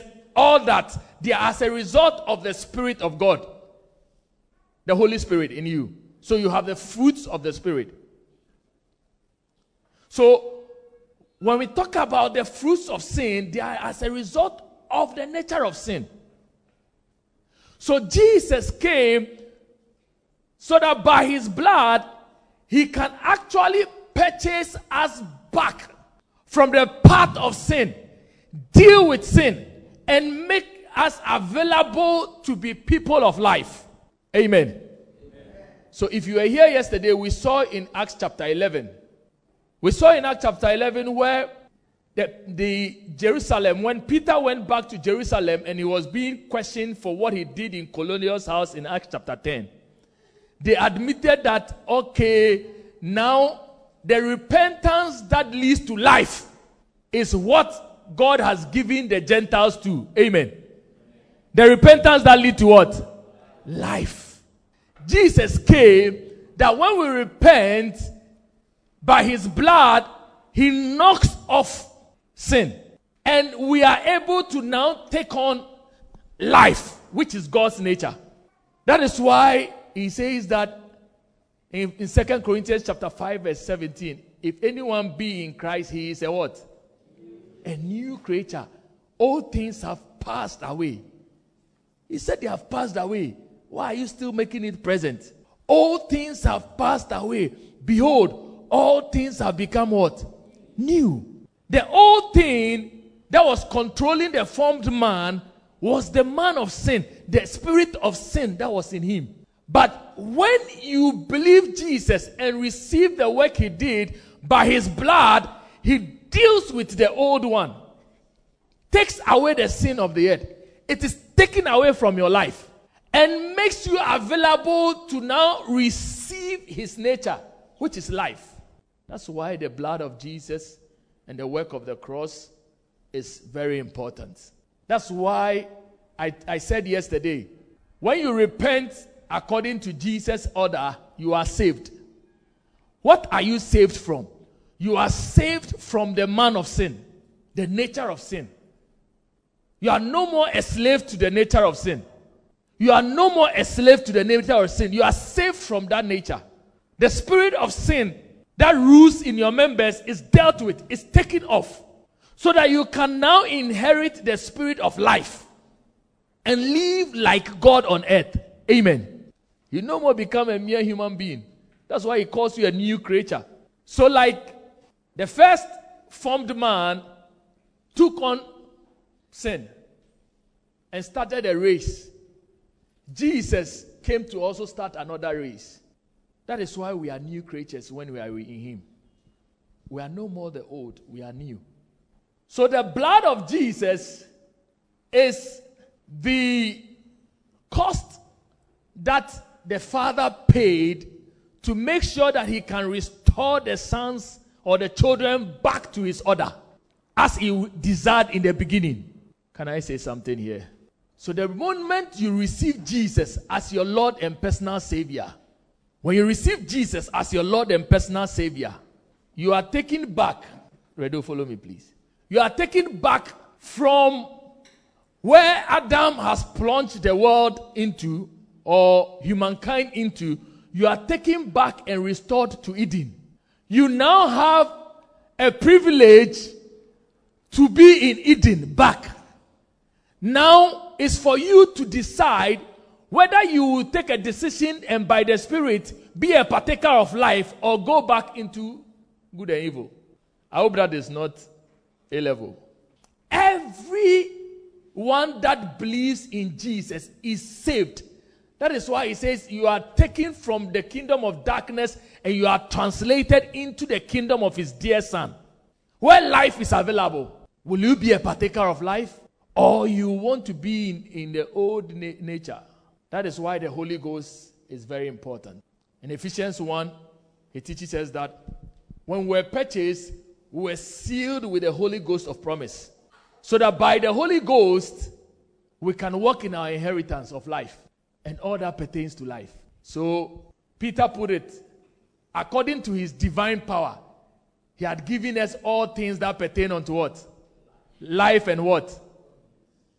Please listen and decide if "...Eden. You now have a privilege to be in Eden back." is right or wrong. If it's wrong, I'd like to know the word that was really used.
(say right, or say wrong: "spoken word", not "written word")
right.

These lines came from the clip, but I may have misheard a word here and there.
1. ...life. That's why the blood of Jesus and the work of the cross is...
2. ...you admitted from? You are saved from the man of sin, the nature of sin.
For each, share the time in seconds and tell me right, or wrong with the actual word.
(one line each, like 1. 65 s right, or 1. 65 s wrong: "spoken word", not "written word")
1. 128 s right
2. 143 s wrong: "saved", not "admitted".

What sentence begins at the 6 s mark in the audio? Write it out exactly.
So you have the fruits of the Spirit.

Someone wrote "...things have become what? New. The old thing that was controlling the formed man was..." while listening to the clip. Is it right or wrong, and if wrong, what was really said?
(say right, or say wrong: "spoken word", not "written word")
right.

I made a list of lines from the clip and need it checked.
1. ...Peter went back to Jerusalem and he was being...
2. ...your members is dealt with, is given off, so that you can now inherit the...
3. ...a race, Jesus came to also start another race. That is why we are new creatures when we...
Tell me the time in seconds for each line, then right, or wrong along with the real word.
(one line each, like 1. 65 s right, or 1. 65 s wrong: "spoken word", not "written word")
1. 44 s right
2. 159 s wrong: "taken", not "given"
3. 181 s right.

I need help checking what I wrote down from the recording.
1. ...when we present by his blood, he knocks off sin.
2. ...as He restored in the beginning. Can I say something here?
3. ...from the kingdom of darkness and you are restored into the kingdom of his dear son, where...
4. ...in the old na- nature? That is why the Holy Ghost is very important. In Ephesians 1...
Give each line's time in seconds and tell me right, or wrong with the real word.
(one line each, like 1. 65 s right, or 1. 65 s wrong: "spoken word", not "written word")
1. 66 s wrong: "repent", not "present"
2. 207 s wrong: "desired", not "restored"
3. 260 s wrong: "translated", not "restored"
4. 271 s right.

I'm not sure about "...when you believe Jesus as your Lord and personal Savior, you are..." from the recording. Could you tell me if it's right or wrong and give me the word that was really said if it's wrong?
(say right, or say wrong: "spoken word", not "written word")
wrong: "receive", not "believe".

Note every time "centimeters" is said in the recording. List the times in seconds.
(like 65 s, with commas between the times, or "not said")
not said.